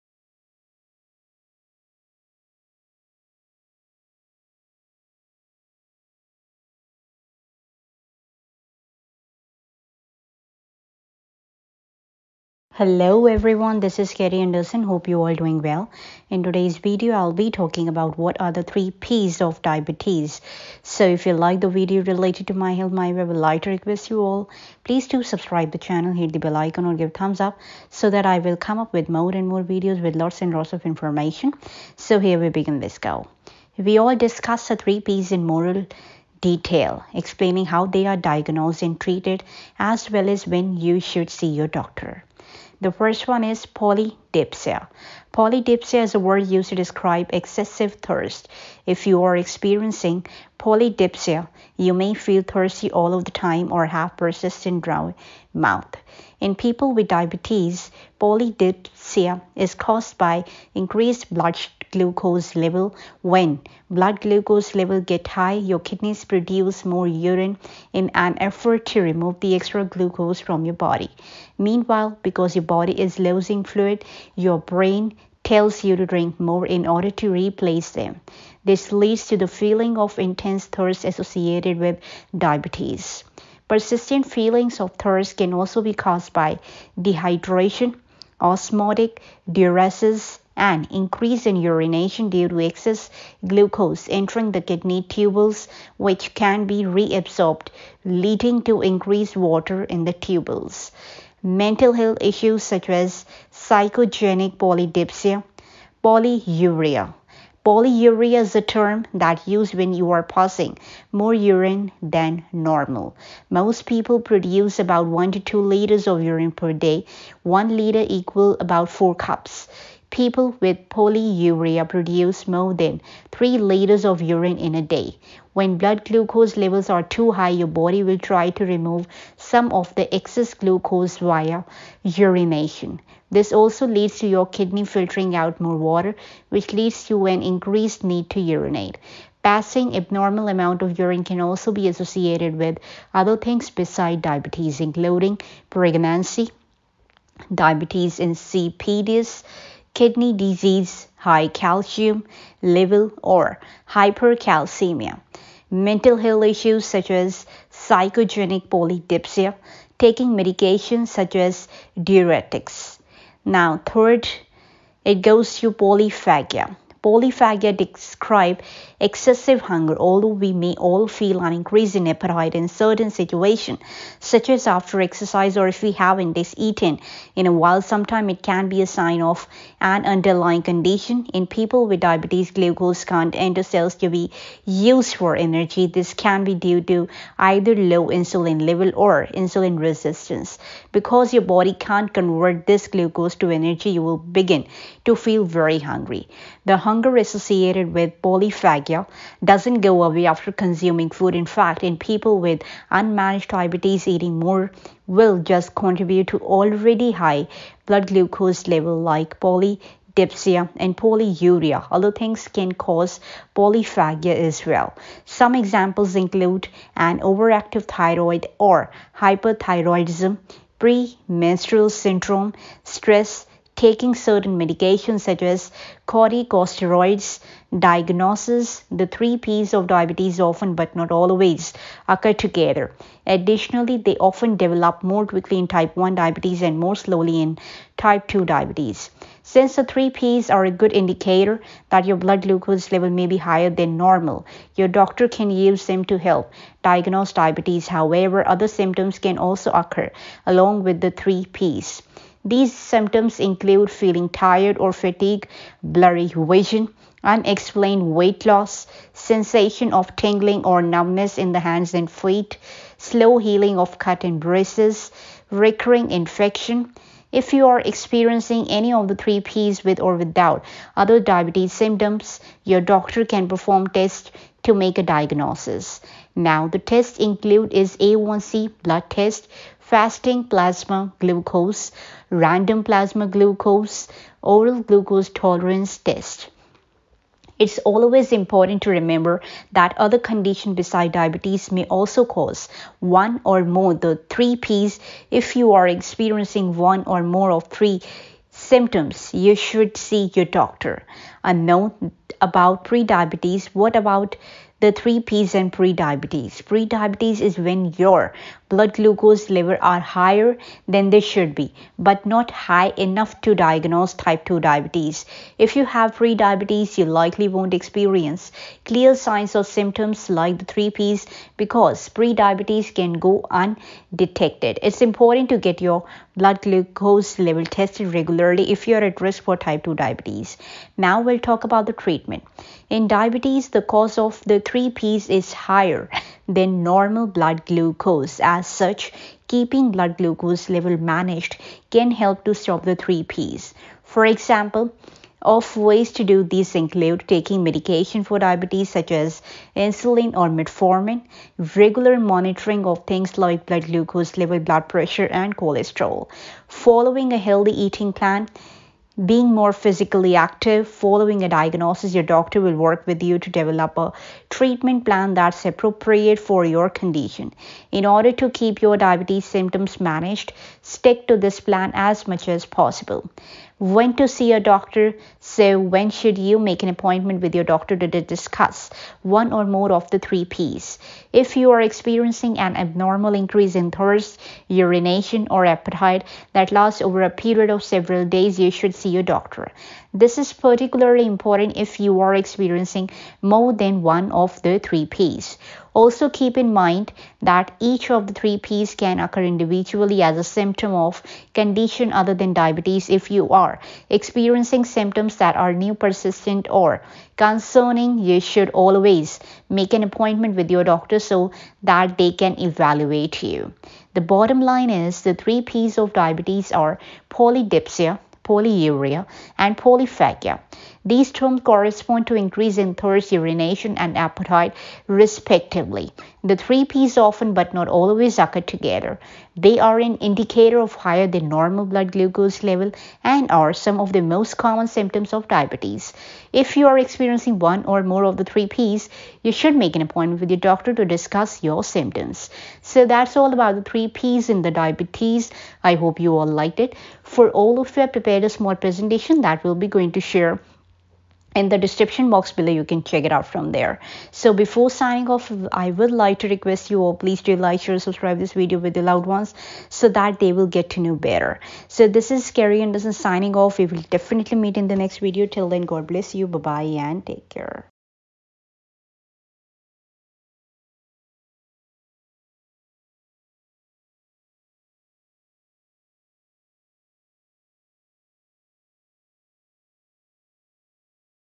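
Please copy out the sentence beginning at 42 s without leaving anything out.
The first one is poly polydipsia.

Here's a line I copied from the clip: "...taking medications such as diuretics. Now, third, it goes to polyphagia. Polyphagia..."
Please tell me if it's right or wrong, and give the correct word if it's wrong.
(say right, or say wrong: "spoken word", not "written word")
right.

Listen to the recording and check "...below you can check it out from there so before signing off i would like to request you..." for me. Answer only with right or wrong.
right.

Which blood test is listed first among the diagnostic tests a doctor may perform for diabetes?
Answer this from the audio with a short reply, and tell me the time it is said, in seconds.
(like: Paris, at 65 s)
A1C, at 277 s.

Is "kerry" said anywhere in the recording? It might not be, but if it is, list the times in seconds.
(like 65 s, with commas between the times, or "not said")
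14 s, 462 s.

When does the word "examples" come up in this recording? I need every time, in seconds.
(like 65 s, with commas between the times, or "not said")
215 s, 344 s.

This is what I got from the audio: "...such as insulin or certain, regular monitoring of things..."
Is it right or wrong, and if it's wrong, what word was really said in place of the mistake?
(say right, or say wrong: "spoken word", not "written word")
wrong: "metformin", not "certain".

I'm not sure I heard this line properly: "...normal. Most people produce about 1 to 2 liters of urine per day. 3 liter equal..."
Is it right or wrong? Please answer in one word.
wrong.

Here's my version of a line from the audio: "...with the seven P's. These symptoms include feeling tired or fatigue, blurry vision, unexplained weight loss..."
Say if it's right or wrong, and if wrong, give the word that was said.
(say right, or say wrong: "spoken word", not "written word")
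wrong: "three", not "seven".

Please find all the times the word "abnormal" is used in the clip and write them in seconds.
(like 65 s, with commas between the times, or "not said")
139 s, 382 s.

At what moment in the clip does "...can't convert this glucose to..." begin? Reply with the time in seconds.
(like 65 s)
191 s.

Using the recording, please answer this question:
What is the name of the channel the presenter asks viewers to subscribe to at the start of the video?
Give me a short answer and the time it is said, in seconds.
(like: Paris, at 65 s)
My Health My Way, at 22 s.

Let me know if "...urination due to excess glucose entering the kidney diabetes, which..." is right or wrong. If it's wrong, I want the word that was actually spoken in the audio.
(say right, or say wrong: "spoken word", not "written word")
wrong: "tubules", not "diabetes".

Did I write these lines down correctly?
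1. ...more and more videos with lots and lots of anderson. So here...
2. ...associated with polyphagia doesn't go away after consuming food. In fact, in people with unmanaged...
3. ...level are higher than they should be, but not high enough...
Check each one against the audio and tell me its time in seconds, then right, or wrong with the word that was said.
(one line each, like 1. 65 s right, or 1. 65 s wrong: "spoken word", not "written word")
1. 29 s wrong: "information", not "anderson"
2. 197 s right
3. 309 s right.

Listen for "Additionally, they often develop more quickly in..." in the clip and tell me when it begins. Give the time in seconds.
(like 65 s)
233 s.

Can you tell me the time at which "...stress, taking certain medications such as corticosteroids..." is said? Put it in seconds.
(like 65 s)
222 s.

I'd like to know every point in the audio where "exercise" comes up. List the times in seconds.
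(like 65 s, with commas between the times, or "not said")
175 s.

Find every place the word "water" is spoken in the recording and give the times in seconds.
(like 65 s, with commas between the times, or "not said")
99 s, 135 s.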